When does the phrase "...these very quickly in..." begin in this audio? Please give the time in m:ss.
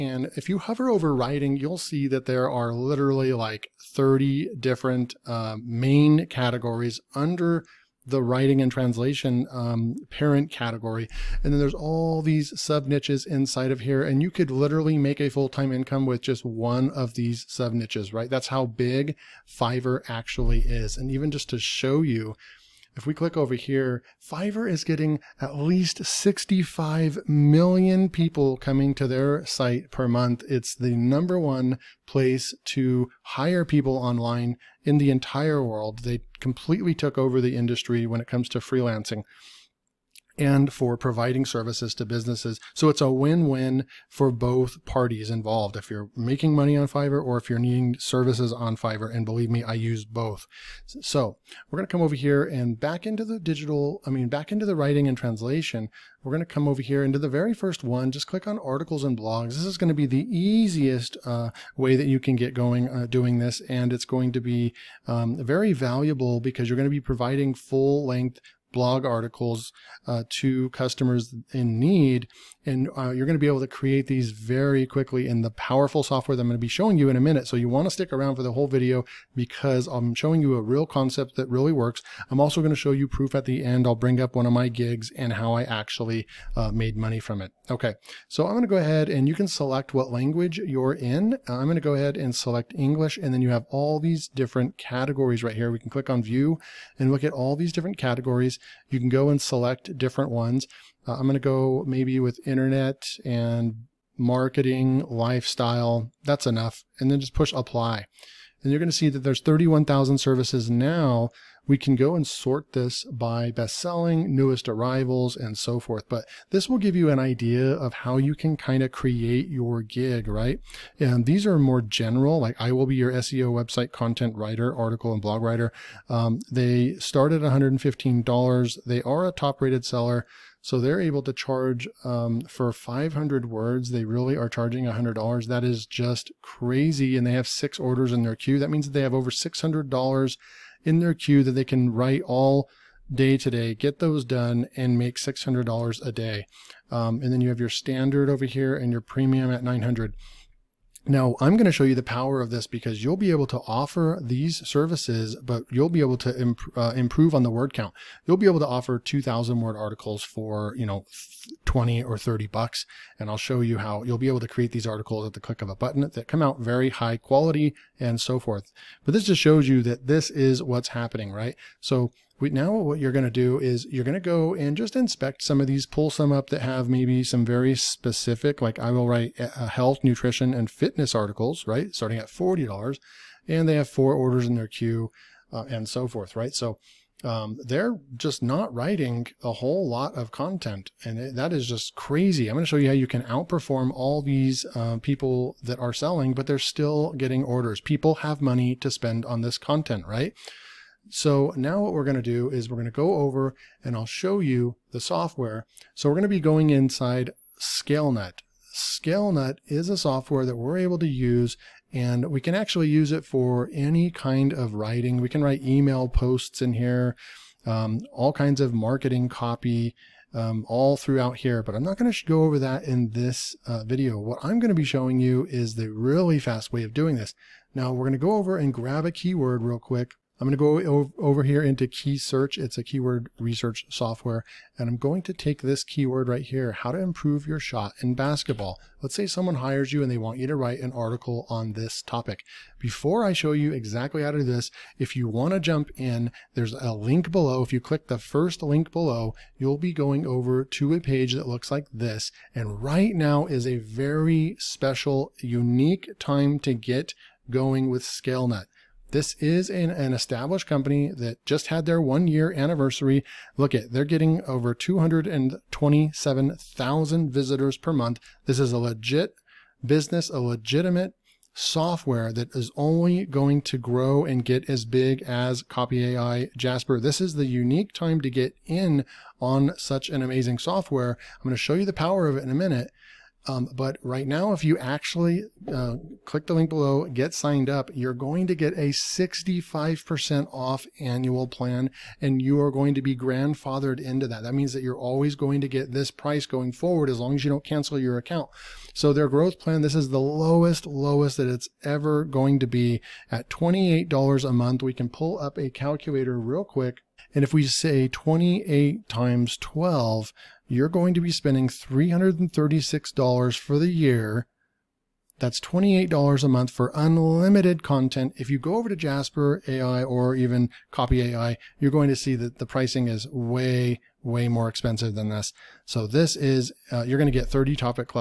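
1:14.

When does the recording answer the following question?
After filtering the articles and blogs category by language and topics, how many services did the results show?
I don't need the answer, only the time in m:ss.
1:49.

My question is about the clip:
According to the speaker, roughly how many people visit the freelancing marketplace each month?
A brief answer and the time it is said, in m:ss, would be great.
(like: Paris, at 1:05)
65 million, at 0:26.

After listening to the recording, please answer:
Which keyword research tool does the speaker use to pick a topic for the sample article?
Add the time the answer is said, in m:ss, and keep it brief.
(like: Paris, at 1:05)
Keysearch, at 3:51.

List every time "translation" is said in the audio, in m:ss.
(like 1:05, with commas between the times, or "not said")
0:08, 0:55.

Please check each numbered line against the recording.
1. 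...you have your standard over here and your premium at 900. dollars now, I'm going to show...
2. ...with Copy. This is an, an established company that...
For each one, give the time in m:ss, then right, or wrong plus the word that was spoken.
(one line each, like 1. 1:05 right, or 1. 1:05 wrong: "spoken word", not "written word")
1. 2:27 right
2. 4:17 wrong: "Scalenut", not "Copy".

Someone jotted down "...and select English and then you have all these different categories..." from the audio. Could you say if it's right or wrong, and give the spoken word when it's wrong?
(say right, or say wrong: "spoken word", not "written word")
right.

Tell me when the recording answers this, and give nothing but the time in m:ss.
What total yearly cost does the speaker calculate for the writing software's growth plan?
5:11.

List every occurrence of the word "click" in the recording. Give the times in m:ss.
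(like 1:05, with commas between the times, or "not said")
0:23, 0:58, 1:35, 2:45, 4:07, 4:46.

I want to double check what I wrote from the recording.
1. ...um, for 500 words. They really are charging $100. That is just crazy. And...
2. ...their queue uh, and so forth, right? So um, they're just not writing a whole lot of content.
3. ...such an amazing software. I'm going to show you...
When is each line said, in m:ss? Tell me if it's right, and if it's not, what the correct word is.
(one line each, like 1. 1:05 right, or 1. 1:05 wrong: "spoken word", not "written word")
1. 2:12 right
2. 3:04 right
3. 4:39 right.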